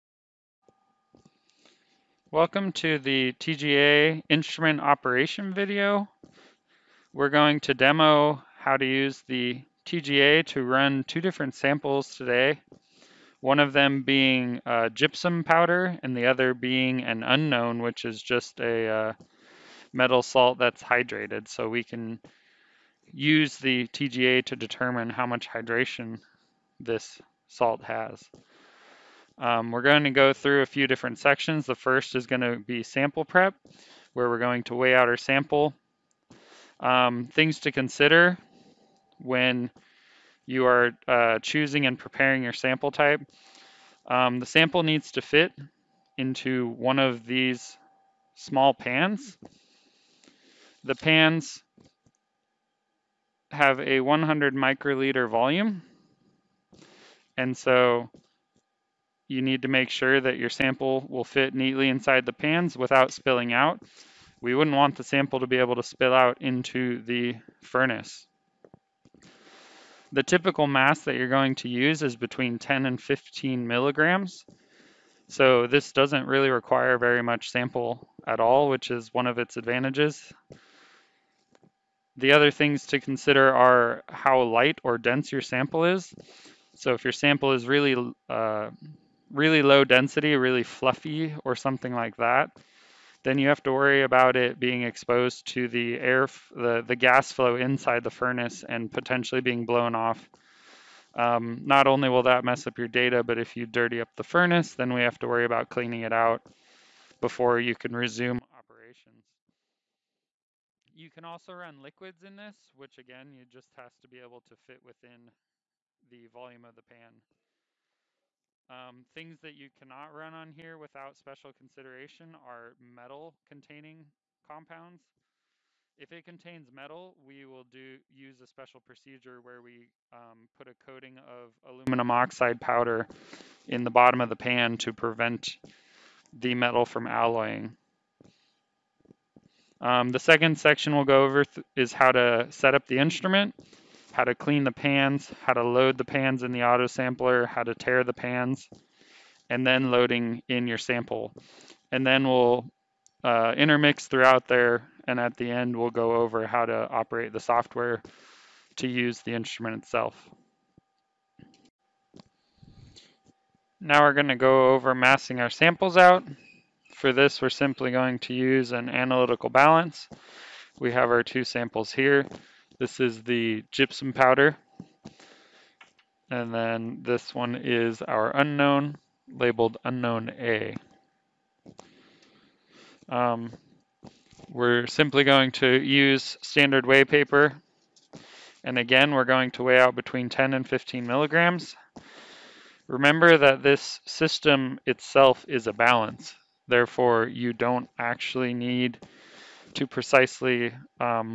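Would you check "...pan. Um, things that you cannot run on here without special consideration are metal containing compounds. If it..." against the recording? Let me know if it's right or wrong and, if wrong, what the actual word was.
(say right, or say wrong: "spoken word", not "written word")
right.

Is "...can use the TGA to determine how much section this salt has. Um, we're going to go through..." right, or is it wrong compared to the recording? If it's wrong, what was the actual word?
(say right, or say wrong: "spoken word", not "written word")
wrong: "hydration", not "section".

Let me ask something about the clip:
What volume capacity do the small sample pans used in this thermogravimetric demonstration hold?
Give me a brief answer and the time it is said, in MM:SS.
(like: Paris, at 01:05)
100 microliters, at 00:54.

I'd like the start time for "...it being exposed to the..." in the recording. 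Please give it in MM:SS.
01:34.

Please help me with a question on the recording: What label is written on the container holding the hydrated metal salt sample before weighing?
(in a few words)
unknown A.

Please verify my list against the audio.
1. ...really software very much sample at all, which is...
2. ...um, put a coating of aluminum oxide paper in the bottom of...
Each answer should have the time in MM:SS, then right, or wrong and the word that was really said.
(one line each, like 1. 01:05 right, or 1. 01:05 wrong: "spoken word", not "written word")
1. 01:16 wrong: "require", not "software"
2. 02:10 wrong: "powder", not "paper".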